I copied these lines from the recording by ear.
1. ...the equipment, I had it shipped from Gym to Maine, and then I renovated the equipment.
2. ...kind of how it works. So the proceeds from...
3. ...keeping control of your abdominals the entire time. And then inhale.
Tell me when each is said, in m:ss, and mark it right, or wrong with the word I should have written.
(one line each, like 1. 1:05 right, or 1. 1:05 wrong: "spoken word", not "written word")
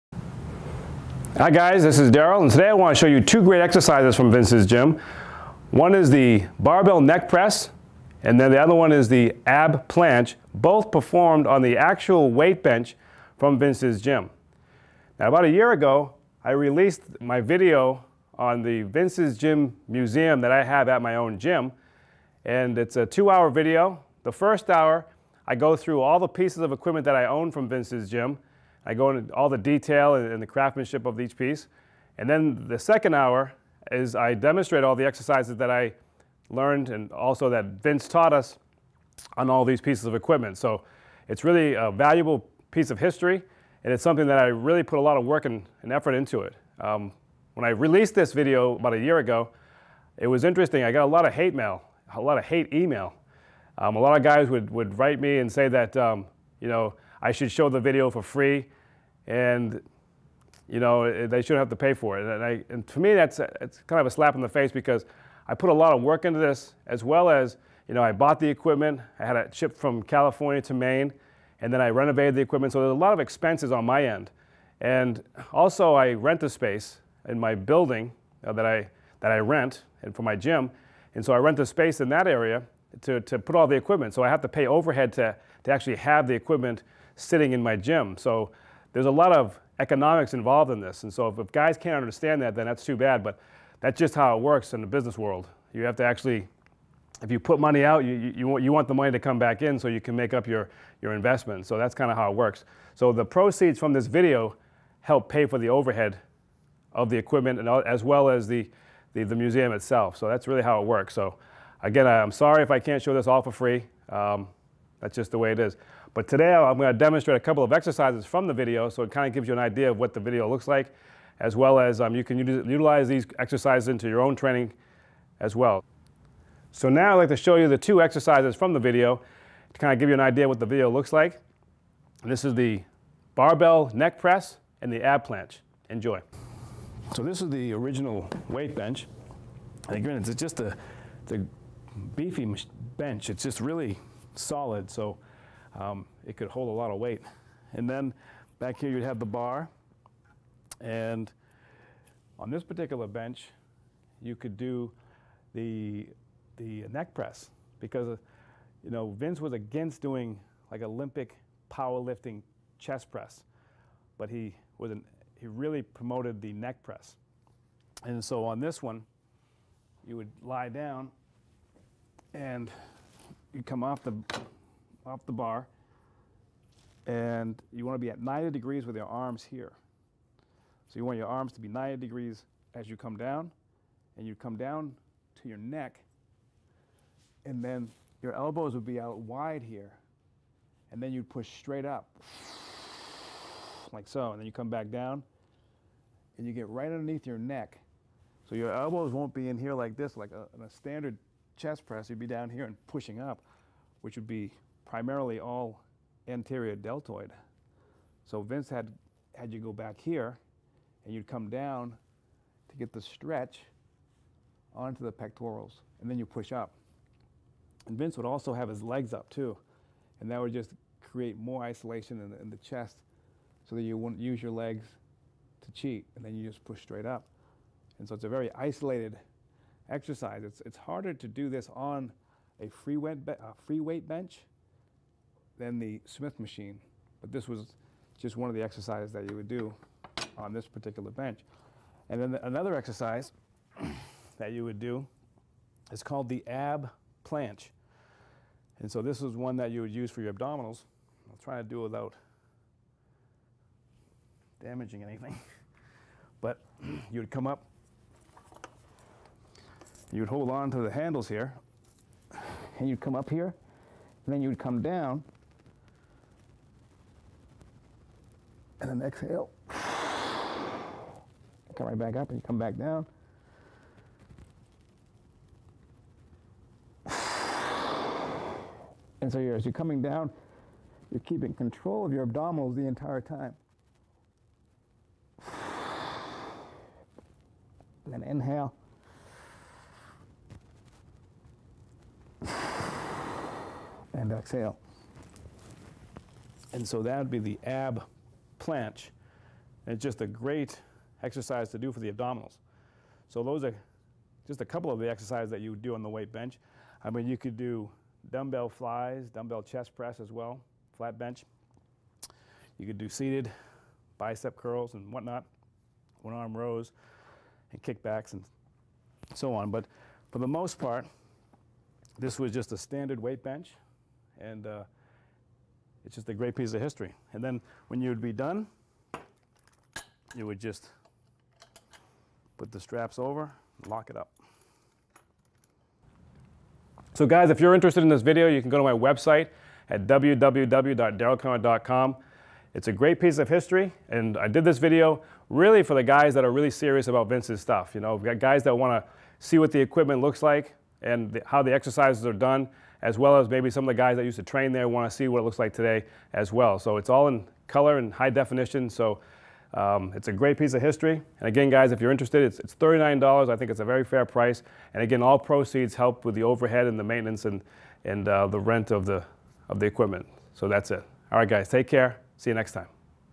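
1. 1:08 wrong: "California", not "Gym"
2. 1:41 right
3. 4:41 right.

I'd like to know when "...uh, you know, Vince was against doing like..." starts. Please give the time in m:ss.
2:38.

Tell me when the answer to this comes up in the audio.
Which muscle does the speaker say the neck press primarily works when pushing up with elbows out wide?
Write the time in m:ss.
3:26.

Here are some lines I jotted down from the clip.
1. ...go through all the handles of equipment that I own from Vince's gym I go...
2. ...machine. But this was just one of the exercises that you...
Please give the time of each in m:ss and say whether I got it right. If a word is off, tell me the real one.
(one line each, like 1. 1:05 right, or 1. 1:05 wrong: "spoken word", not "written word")
1. 0:25 wrong: "pieces", not "handles"
2. 3:56 right.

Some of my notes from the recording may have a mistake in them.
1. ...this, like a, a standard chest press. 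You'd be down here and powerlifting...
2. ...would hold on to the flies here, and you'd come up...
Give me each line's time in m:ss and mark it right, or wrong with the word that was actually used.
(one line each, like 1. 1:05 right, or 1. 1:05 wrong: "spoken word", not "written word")
1. 3:19 wrong: "pushing", not "powerlifting"
2. 4:20 wrong: "handles", not "flies".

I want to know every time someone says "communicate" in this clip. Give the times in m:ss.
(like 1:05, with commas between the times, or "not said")
not said.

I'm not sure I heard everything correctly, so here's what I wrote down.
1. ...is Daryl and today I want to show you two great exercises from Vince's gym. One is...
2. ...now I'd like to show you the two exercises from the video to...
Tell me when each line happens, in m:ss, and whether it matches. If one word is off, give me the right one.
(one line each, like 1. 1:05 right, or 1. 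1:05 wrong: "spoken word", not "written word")
1. 0:01 right
2. 2:06 right.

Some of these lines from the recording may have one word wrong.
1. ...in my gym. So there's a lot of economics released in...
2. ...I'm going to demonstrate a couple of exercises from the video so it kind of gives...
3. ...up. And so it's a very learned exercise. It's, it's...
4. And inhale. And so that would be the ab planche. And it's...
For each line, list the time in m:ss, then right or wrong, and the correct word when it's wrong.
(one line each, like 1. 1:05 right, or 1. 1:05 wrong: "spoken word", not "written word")
1. 1:27 wrong: "involved", not "released"
2. 1:56 right
3. 3:47 wrong: "isolated", not "learned"
4. 4:54 wrong: "exhale", not "inhale".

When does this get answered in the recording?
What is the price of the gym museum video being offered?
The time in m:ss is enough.
6:02.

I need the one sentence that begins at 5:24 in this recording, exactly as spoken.
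And uh, it's just a great piece of history.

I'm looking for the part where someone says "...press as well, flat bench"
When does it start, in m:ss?
5:09.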